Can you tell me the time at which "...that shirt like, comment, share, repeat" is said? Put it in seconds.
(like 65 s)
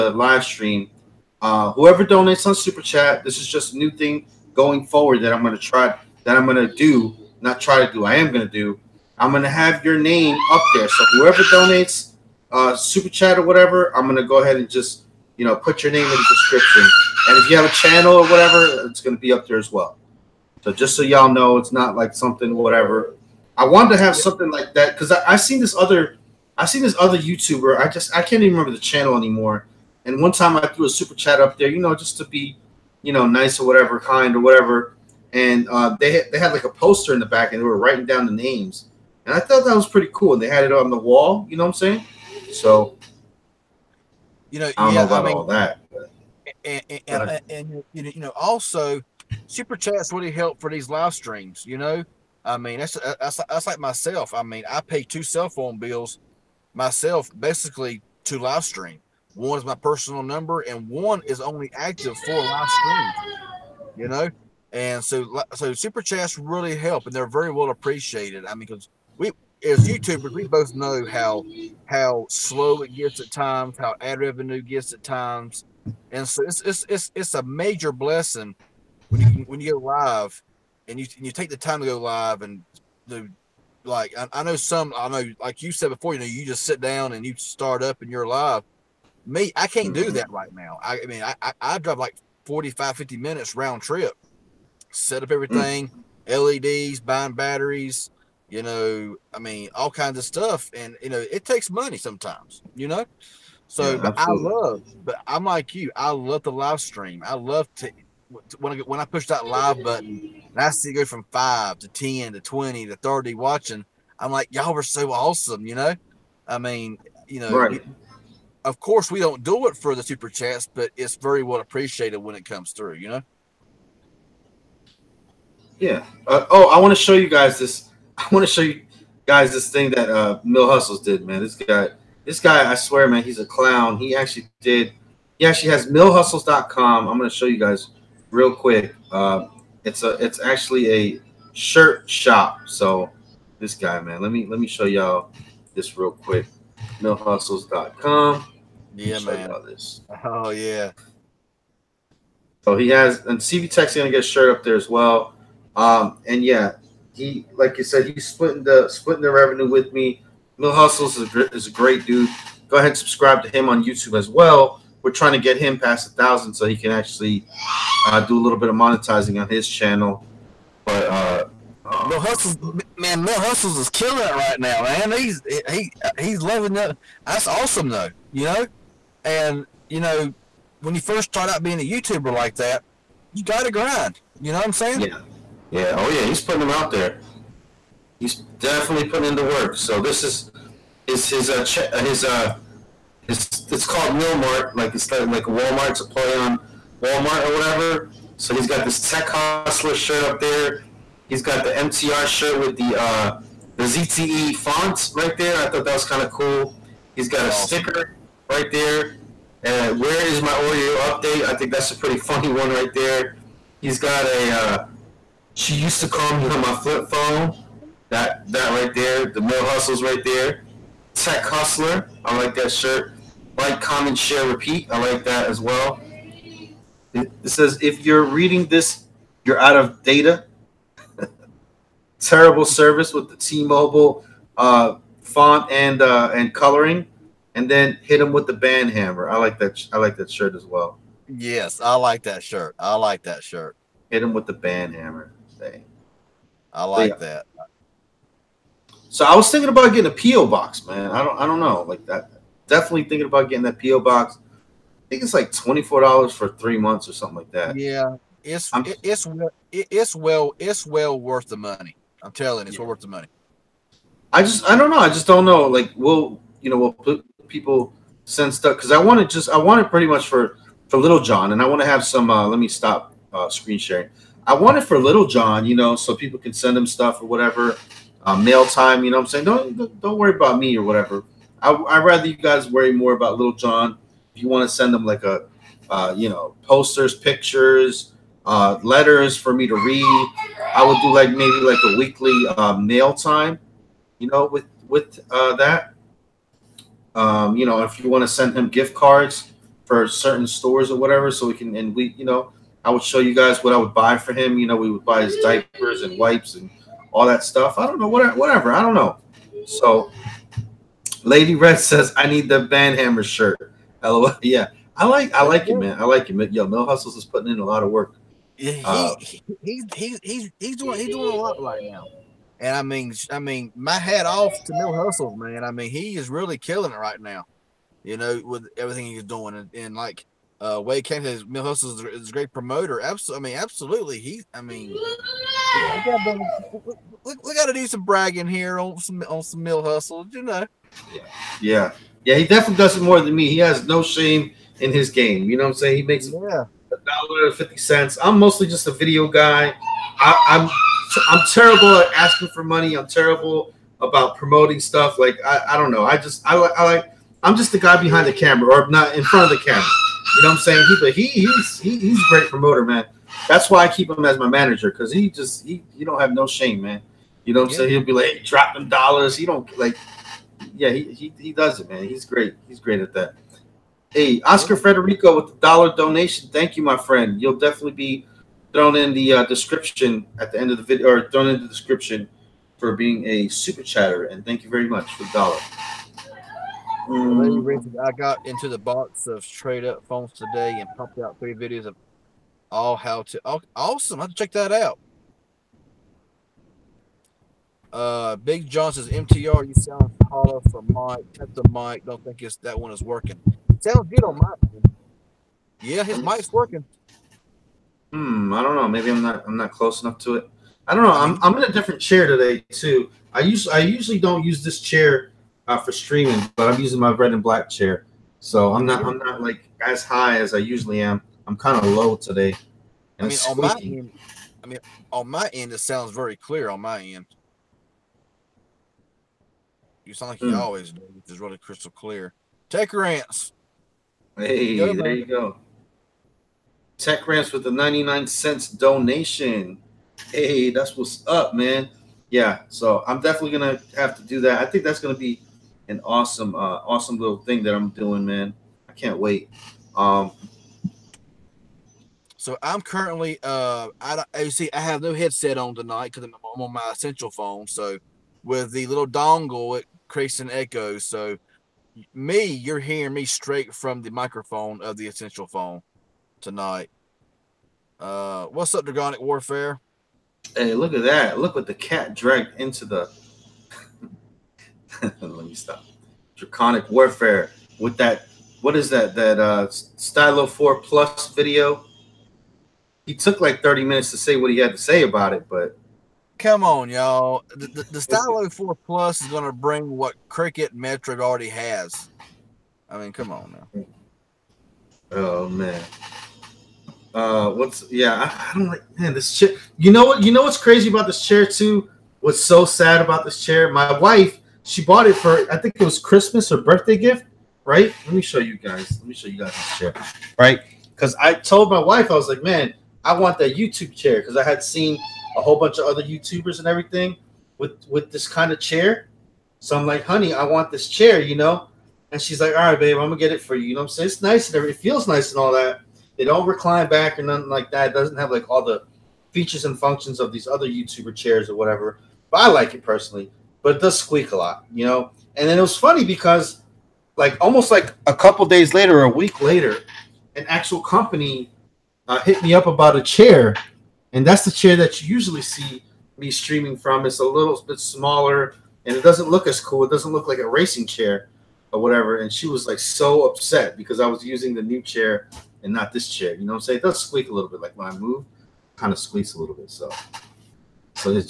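222 s.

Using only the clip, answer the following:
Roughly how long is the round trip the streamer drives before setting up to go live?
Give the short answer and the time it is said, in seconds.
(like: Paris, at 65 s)
45 to 50 minutes, at 92 s.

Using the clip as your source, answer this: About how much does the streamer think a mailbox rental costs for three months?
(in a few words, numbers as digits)
$24.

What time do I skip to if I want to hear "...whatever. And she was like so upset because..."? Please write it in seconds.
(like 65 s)
551 s.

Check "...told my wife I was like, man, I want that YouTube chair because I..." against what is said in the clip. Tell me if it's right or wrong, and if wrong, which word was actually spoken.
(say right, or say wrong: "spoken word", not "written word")
right.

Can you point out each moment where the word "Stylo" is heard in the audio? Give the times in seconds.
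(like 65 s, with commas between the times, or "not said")
479 s, 488 s.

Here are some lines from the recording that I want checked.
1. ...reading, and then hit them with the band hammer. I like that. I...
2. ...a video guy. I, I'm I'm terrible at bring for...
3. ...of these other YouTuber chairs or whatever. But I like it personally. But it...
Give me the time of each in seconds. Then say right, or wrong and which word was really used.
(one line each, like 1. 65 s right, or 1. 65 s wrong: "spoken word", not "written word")
1. 236 s wrong: "coloring", not "reading"
2. 348 s wrong: "asking", not "bring"
3. 530 s right.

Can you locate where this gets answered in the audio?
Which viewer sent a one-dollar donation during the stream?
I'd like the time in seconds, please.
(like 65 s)
374 s.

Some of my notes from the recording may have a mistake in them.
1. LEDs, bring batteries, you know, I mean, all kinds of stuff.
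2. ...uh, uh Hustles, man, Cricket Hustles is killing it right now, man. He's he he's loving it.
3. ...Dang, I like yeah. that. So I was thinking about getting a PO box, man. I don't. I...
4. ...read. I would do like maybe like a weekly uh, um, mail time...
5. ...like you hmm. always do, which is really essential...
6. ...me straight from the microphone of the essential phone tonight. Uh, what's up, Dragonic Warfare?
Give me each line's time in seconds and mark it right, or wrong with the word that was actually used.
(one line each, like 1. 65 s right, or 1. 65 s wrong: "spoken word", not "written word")
1. 96 s wrong: "buying", not "bring"
2. 171 s wrong: "Mel", not "Cricket"
3. 245 s right
4. 289 s right
5. 430 s wrong: "crystal", not "essential"
6. 463 s right.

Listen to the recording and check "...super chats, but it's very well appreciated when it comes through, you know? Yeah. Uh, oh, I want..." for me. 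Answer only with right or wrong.
right.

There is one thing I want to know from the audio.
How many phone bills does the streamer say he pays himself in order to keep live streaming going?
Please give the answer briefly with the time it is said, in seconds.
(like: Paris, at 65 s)
2, at 55 s.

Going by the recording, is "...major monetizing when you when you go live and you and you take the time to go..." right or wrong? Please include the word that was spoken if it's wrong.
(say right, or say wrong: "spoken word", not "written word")
wrong: "blessing", not "monetizing".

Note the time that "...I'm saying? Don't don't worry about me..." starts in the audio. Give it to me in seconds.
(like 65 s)
279 s.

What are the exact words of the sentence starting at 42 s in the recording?
So, you know, I don't yeah, know about I mean, all that.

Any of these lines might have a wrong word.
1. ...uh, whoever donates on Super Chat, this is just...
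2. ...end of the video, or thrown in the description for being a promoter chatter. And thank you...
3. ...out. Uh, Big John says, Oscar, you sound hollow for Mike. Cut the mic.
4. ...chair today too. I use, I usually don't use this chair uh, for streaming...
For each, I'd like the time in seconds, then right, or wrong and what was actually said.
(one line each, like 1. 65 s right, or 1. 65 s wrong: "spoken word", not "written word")
1. 1 s right
2. 380 s wrong: "super", not "promoter"
3. 394 s wrong: "MTR", not "Oscar"
4. 412 s right.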